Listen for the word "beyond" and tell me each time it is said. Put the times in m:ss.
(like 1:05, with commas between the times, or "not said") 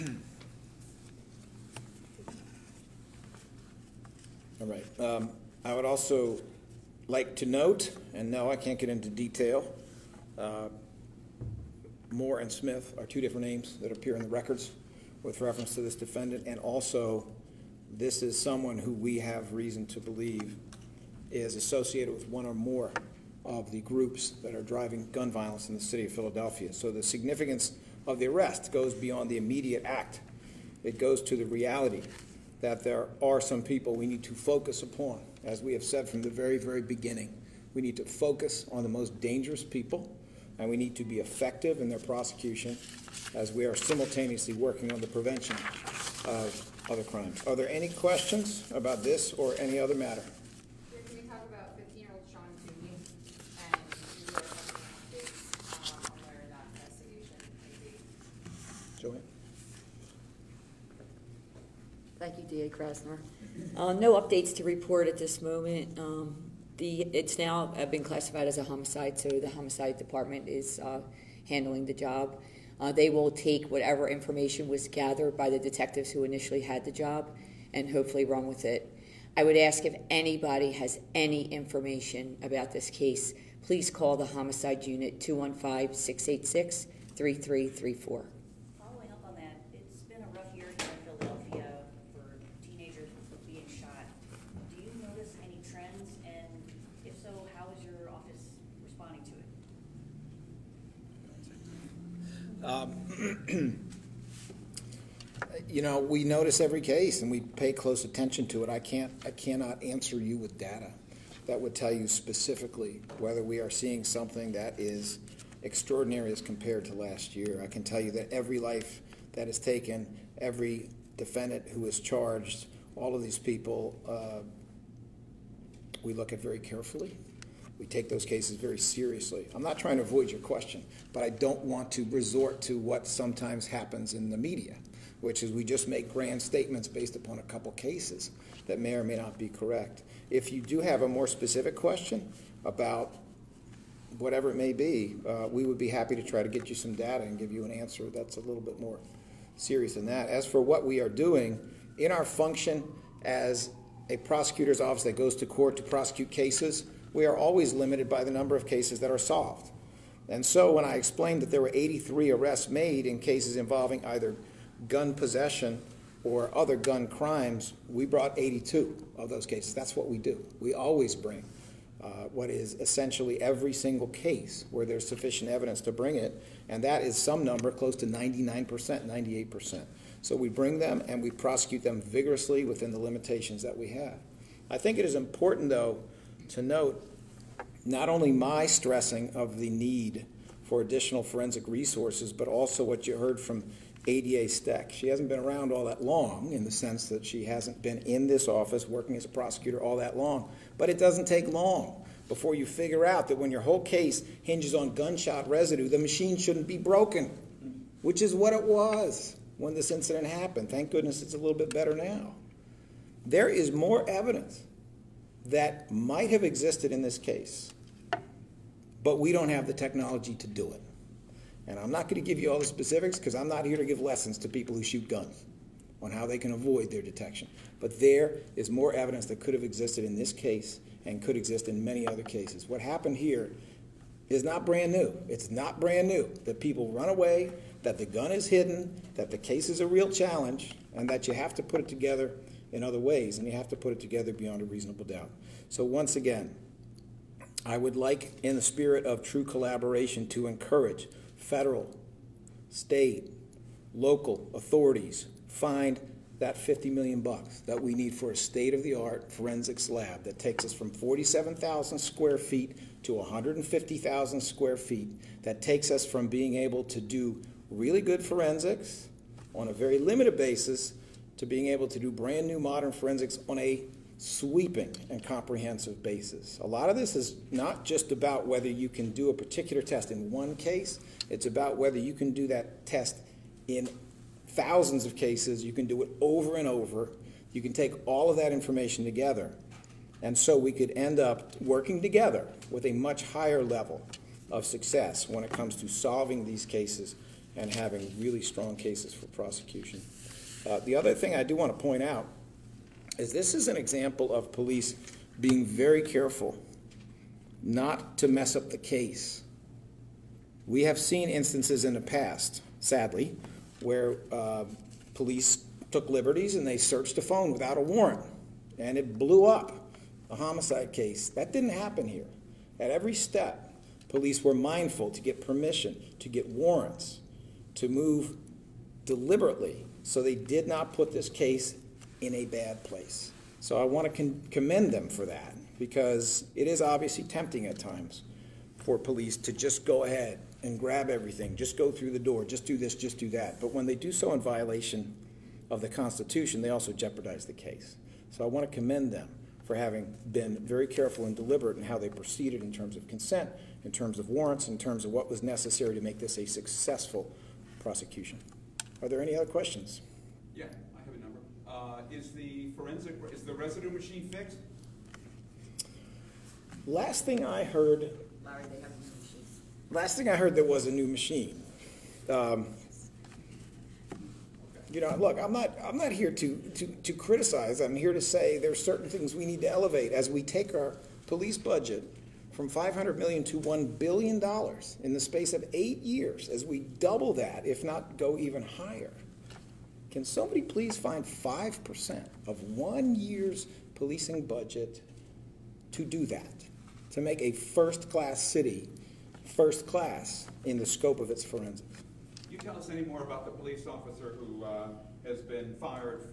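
0:28, 4:04.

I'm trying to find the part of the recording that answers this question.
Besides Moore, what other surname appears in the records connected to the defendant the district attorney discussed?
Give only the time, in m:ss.
0:12.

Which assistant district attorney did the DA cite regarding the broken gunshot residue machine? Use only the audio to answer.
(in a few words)
ADA Stack.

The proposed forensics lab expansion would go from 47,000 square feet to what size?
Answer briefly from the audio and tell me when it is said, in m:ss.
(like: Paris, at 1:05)
150,000 square feet, at 4:23.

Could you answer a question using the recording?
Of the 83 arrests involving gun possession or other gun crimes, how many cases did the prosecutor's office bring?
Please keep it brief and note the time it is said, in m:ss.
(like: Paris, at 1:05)
82, at 2:48.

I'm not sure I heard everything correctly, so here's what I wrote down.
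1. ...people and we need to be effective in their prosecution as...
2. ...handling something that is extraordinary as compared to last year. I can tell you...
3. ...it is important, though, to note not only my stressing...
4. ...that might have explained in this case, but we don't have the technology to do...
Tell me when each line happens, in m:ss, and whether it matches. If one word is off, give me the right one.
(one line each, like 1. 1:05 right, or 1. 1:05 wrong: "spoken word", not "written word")
1. 0:39 right
2. 1:53 wrong: "seeing", not "handling"
3. 3:04 right
4. 3:35 wrong: "existed", not "explained".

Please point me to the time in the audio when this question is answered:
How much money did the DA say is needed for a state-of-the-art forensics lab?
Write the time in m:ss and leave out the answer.
4:16.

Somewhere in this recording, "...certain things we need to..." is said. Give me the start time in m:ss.
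6:18.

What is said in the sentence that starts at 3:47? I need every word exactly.
But there is more evidence that could have existed in this case and could exist in many other cases.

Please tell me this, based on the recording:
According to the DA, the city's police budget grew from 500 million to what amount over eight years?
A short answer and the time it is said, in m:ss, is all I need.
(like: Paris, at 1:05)
1 billion dollars, at 6:23.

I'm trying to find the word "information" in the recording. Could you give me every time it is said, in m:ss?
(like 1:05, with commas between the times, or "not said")
1:14, 1:21, 4:48.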